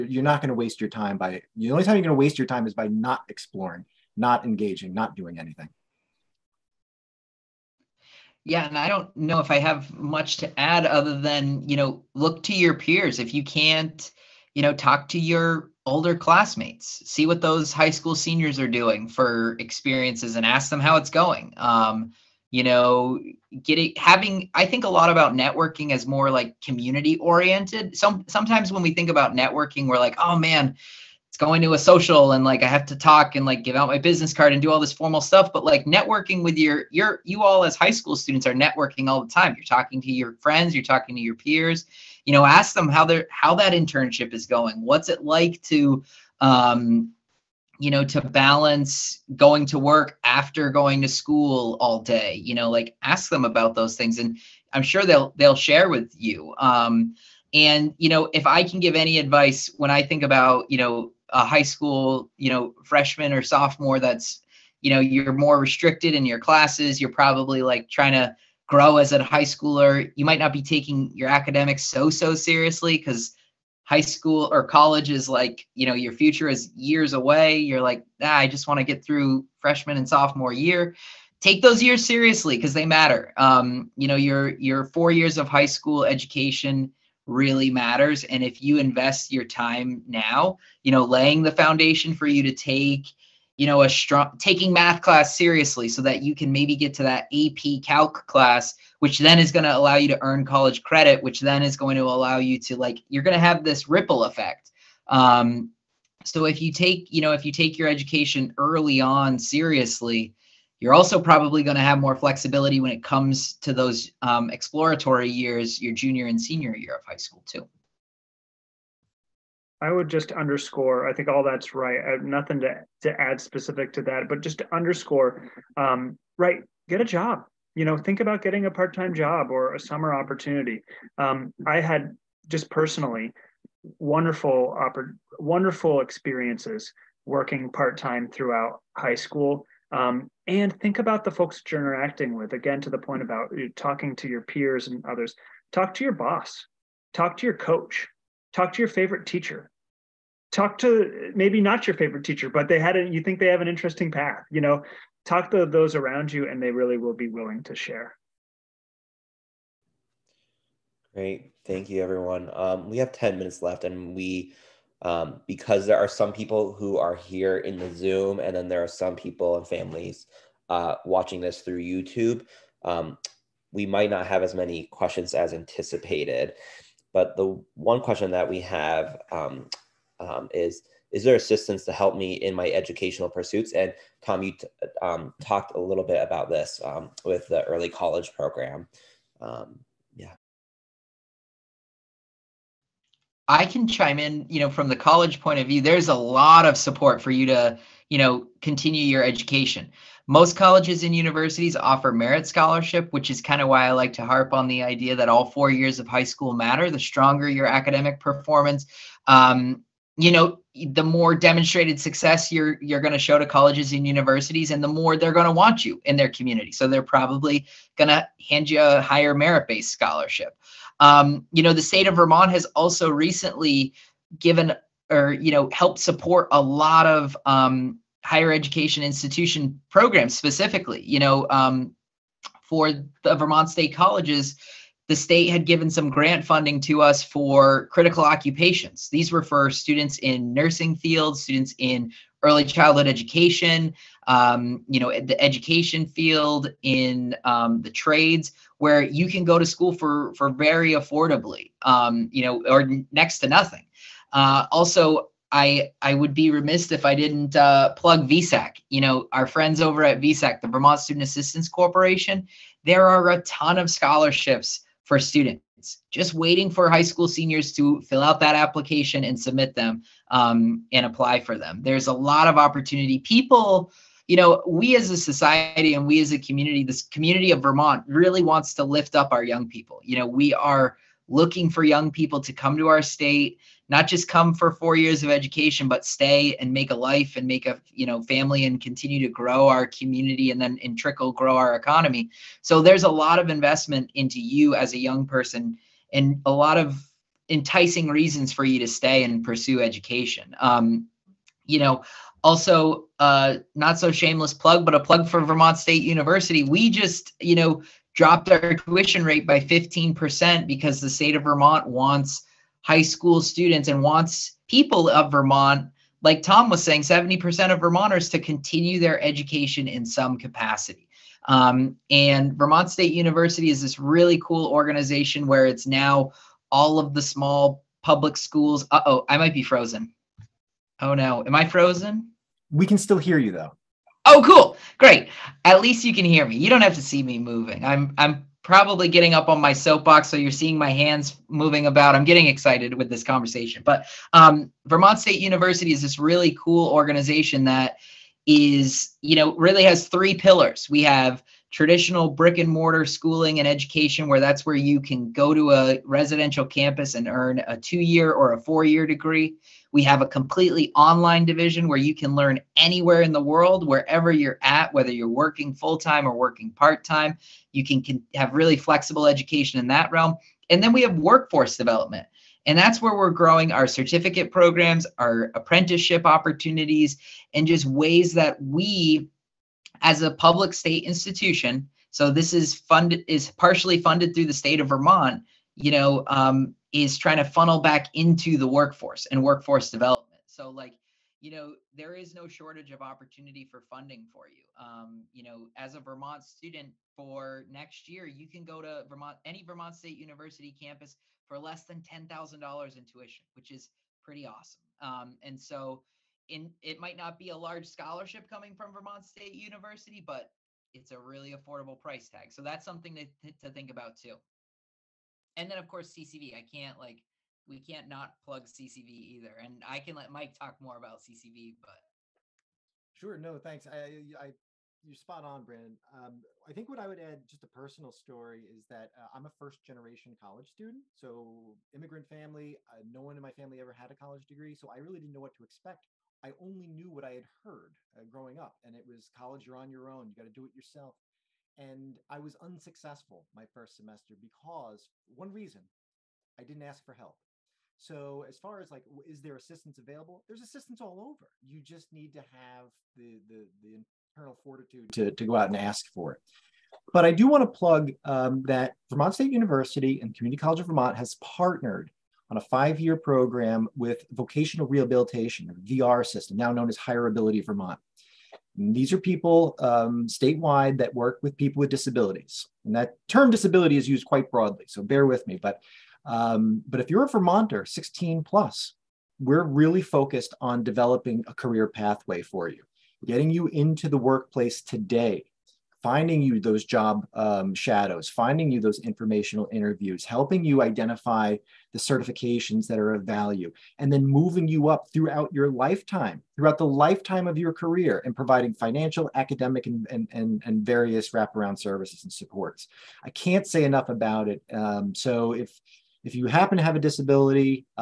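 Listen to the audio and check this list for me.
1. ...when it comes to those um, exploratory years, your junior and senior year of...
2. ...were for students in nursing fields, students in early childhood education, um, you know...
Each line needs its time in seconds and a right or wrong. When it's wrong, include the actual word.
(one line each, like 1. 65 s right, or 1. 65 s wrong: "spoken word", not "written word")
1. 112 s right
2. 239 s right.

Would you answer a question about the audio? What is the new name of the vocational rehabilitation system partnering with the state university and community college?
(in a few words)
HireAbility Vermont.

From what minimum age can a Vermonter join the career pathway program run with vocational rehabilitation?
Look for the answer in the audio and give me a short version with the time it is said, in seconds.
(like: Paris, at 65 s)
16, at 477 s.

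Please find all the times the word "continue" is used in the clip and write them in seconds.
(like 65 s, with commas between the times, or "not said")
198 s, 288 s, 318 s.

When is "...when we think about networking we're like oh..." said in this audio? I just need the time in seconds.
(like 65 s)
28 s.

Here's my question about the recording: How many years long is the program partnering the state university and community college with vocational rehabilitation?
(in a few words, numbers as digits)
5.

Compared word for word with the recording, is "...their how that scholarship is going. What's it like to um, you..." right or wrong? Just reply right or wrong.
wrong.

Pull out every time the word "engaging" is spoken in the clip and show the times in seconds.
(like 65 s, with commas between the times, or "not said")
4 s.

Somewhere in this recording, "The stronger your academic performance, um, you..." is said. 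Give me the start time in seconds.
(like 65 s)
206 s.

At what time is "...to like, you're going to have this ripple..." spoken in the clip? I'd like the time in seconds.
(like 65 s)
102 s.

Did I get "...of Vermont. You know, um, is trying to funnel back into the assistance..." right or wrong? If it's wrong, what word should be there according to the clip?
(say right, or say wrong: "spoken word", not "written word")
wrong: "workforce", not "assistance".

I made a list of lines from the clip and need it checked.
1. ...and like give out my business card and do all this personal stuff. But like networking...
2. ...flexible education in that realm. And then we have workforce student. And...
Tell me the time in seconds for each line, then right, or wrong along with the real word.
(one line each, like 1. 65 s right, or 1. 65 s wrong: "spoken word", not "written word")
1. 33 s wrong: "formal", not "personal"
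2. 368 s wrong: "development", not "student".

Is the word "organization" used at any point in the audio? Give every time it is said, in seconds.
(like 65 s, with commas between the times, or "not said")
324 s, 346 s.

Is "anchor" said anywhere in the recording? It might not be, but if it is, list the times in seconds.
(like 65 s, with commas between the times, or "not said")
not said.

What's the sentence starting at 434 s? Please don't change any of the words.
So, I really didn't know what to expect.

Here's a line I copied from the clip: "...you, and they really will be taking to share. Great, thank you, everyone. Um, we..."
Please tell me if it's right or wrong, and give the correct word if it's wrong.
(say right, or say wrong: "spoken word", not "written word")
wrong: "willing", not "taking".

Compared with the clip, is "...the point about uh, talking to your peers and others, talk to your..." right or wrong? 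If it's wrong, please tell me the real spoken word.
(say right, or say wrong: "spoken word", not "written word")
right.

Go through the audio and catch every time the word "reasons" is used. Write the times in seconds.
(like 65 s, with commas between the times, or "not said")
298 s, 445 s.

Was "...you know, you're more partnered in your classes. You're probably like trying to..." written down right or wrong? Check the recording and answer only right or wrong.
wrong.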